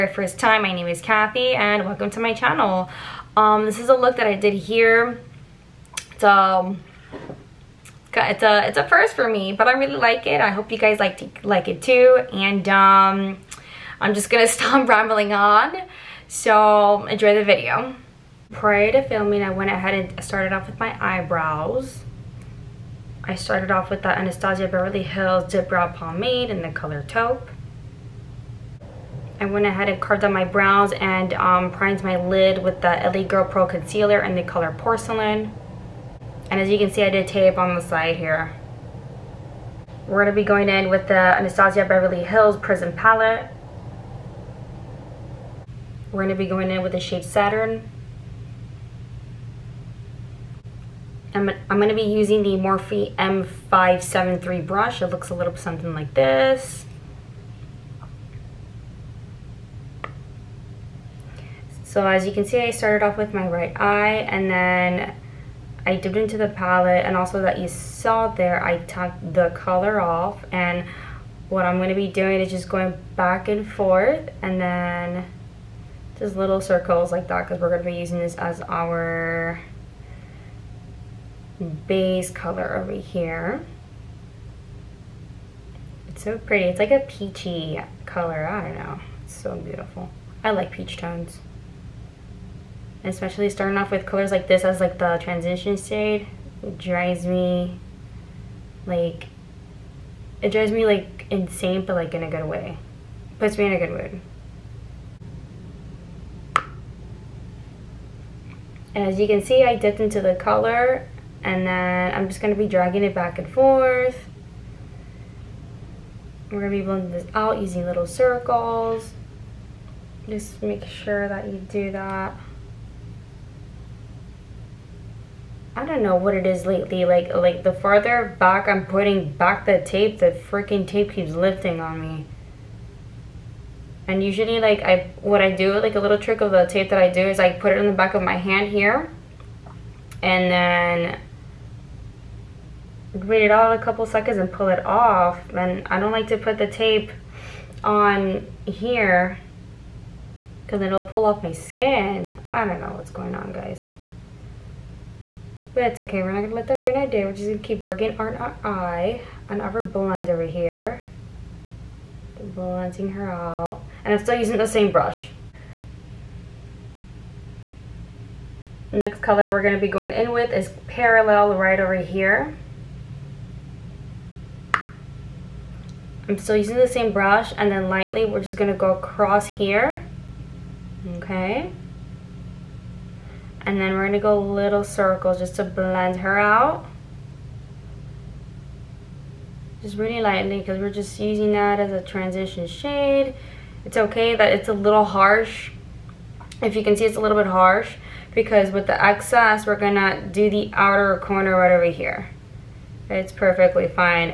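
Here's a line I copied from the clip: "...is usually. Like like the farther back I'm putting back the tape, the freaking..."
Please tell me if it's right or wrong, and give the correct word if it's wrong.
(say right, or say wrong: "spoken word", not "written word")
wrong: "lately", not "usually".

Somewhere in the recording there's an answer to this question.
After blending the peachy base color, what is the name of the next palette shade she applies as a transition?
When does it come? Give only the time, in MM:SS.
02:50.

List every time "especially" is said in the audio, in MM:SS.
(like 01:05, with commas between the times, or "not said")
01:33.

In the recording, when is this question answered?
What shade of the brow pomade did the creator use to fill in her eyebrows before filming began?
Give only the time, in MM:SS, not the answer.
00:27.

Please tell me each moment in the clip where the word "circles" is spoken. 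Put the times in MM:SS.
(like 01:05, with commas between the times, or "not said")
01:16, 01:58, 03:04.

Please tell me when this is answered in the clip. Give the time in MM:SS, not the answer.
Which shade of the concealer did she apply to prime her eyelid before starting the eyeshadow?
00:34.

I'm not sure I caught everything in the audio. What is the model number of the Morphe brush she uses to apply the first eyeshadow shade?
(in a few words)
M573.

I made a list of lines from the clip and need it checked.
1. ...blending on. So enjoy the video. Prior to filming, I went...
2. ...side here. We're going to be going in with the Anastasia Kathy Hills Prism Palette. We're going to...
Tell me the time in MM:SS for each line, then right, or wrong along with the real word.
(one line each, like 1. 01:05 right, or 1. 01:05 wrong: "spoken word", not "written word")
1. 00:14 wrong: "rambling", not "blending"
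2. 00:37 wrong: "Beverly", not "Kathy".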